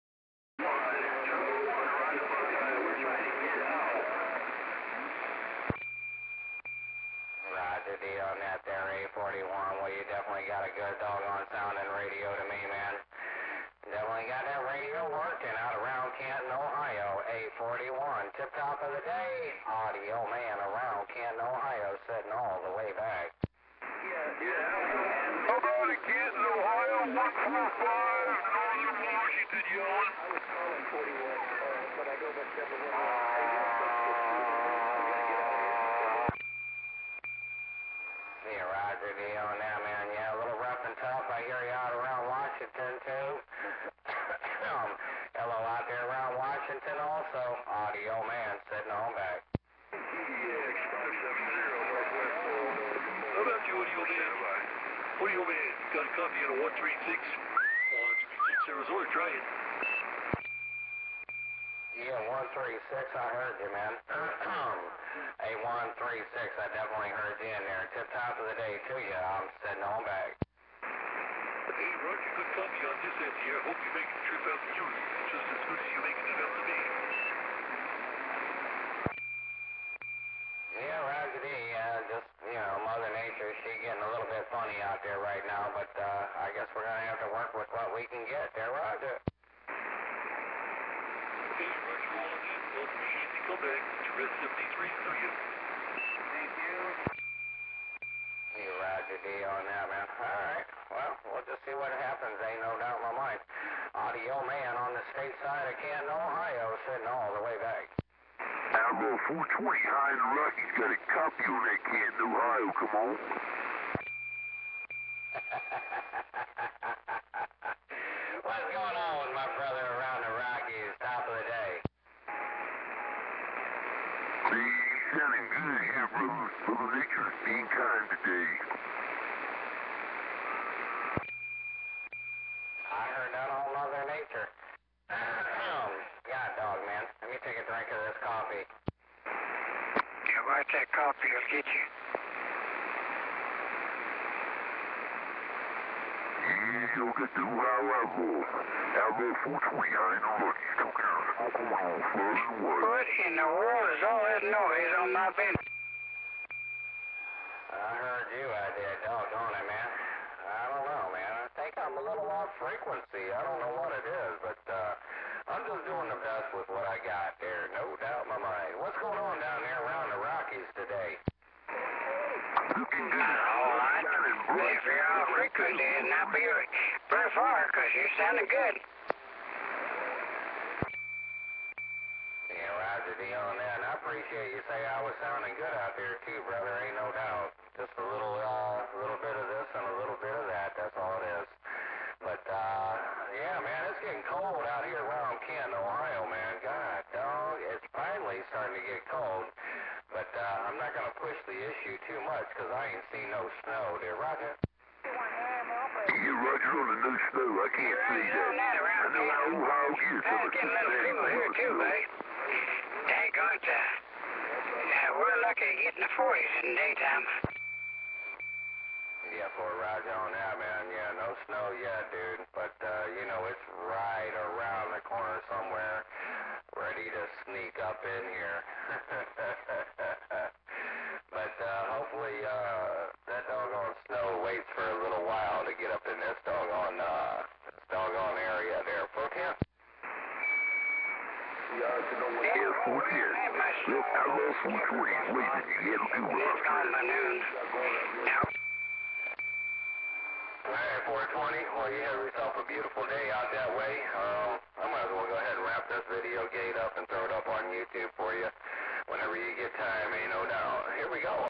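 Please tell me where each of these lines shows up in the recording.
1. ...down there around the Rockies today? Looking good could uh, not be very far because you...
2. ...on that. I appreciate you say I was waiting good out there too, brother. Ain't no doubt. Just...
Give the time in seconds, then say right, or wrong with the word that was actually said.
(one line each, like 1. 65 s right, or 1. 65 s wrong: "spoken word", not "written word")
1. 169 s right
2. 183 s wrong: "sounding", not "waiting".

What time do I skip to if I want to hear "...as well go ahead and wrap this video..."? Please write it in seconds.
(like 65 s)
255 s.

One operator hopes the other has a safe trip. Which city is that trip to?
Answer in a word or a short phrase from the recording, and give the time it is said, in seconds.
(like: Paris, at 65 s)
Houston, at 74 s.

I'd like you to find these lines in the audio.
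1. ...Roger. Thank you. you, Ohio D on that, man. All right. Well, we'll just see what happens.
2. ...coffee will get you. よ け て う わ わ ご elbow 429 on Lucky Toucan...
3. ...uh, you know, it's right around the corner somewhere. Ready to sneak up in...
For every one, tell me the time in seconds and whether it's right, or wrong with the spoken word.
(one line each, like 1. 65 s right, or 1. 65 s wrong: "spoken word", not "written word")
1. 88 s wrong: "Roger", not "Ohio"
2. 140 s right
3. 222 s right.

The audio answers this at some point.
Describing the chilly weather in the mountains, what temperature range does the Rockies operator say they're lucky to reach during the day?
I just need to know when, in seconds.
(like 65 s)
216 s.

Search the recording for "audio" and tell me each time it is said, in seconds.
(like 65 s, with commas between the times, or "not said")
19 s, 103 s.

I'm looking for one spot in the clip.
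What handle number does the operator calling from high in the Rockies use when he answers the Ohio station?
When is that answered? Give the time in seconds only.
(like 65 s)
109 s.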